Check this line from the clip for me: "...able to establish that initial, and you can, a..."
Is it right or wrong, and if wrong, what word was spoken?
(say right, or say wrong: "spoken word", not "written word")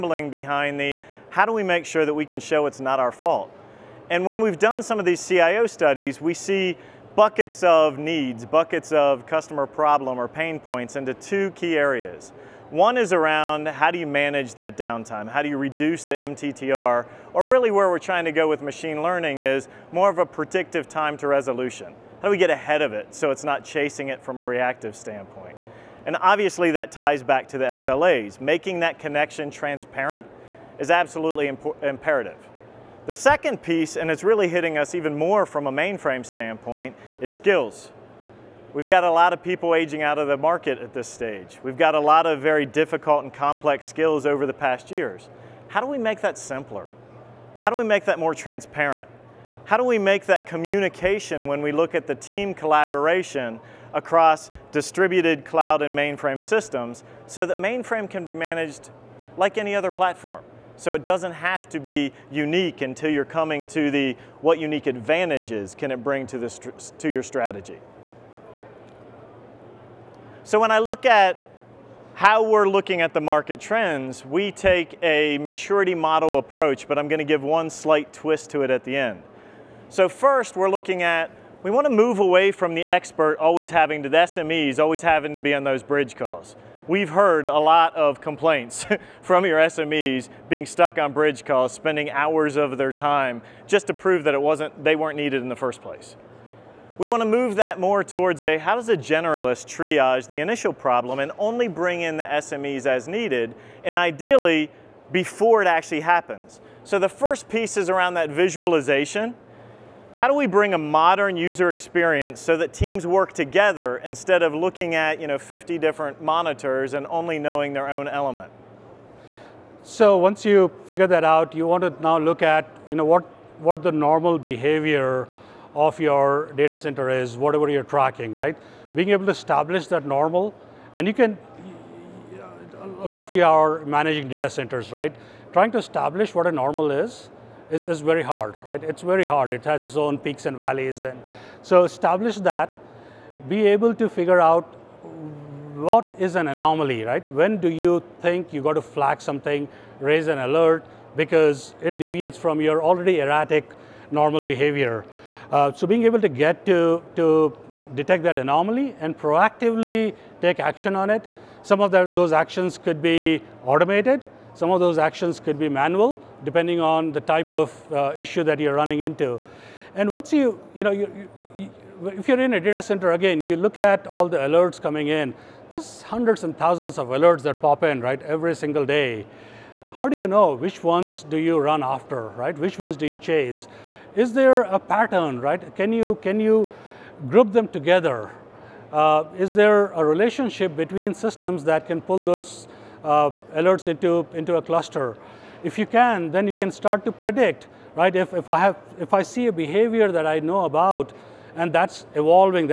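wrong: "normal", not "initial".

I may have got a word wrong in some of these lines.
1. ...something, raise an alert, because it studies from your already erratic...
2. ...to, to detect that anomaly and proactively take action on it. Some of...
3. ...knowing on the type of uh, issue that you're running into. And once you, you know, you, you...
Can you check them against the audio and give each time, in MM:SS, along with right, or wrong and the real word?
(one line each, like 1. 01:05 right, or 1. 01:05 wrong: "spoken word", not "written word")
1. 02:29 wrong: "deviates", not "studies"
2. 02:36 right
3. 02:46 wrong: "depending", not "knowing".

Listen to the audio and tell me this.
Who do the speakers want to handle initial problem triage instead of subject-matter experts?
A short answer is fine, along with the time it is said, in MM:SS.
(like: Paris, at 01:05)
a generalist, at 01:38.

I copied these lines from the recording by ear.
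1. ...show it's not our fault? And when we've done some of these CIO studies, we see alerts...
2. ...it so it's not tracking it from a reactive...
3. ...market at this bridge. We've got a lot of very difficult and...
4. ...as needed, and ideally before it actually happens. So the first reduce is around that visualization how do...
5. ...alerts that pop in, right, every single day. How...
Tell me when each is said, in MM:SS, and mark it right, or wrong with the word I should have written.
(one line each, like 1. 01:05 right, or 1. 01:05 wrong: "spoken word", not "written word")
1. 00:02 wrong: "buckets", not "alerts"
2. 00:22 wrong: "chasing", not "tracking"
3. 00:40 wrong: "stage", not "bridge"
4. 01:42 wrong: "piece", not "reduce"
5. 02:57 right.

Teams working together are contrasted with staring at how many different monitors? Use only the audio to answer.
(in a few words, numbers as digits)
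50.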